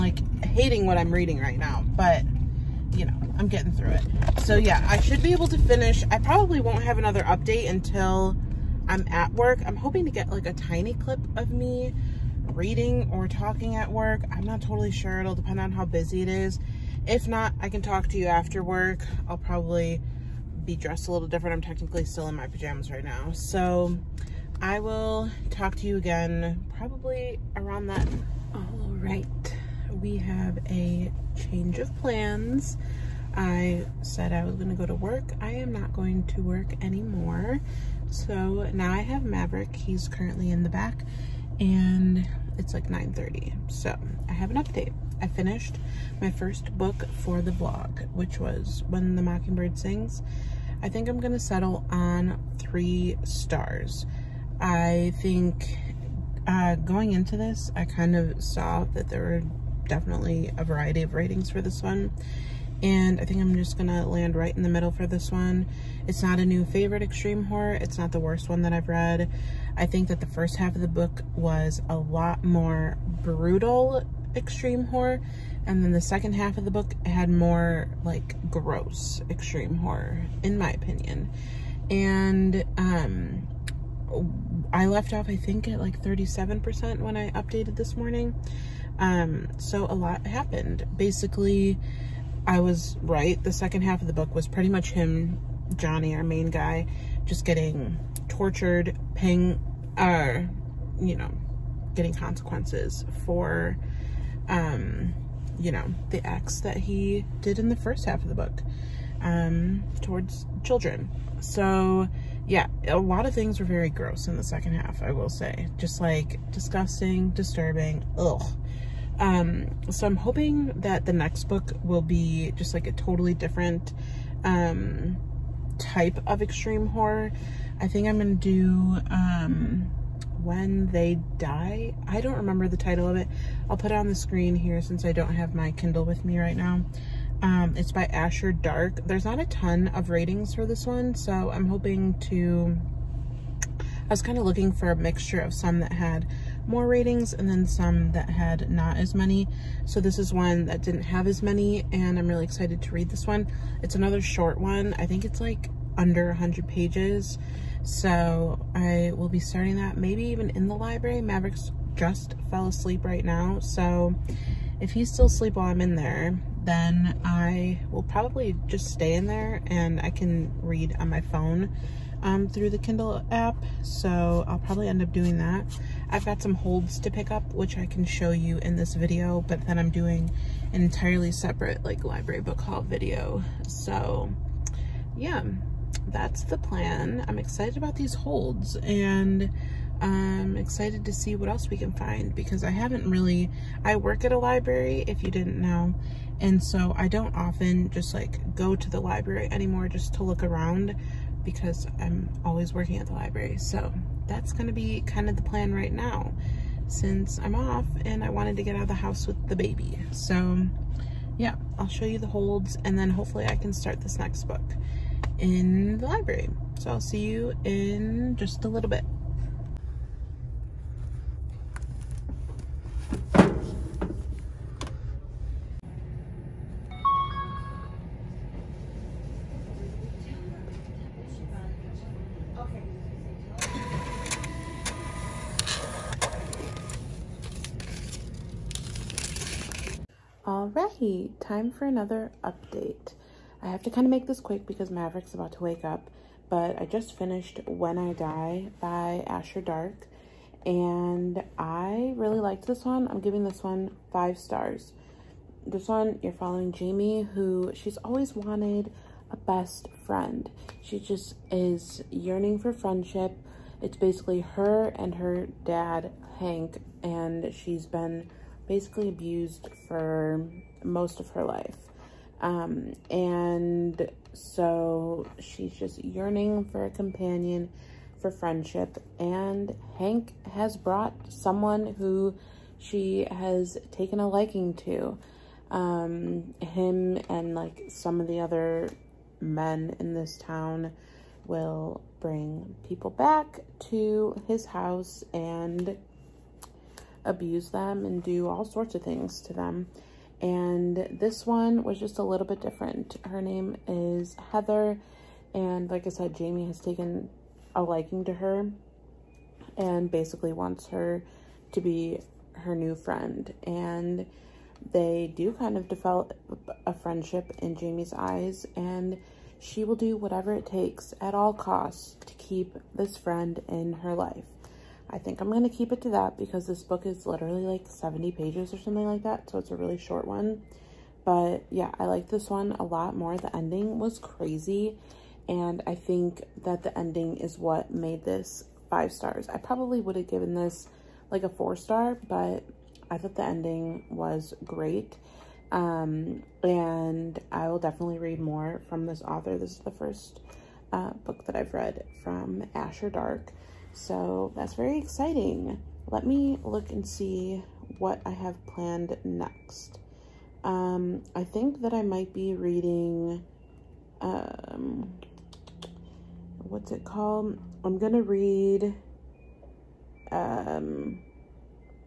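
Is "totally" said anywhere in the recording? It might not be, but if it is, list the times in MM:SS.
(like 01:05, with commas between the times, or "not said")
00:14, 02:02.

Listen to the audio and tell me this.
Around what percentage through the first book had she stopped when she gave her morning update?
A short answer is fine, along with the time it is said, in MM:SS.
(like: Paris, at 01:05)
37%, at 01:26.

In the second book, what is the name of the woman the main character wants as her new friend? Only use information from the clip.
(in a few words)
Heather.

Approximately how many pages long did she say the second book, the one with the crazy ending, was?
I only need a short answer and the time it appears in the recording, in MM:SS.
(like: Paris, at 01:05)
70, at 05:27.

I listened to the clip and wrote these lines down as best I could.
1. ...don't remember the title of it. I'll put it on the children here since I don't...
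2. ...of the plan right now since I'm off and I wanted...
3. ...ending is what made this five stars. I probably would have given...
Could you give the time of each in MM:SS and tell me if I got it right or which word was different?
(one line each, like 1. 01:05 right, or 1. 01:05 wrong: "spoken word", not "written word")
1. 02:12 wrong: "screen", not "children"
2. 03:25 right
3. 05:36 right.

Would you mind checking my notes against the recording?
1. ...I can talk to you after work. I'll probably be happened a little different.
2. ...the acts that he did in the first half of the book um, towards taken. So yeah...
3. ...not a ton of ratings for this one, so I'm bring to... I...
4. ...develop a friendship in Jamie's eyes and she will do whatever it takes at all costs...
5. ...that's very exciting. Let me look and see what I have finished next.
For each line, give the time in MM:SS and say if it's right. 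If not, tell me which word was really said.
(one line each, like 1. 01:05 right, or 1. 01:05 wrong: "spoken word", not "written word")
1. 00:17 wrong: "dressed", not "happened"
2. 01:46 wrong: "children", not "taken"
3. 02:19 wrong: "hoping", not "bring"
4. 05:15 right
5. 05:54 wrong: "planned", not "finished".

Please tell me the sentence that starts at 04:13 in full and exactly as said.
I'm giving this one five stars.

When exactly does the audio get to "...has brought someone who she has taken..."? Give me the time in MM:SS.
04:40.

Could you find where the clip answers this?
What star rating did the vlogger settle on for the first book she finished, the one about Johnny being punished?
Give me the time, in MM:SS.
00:52.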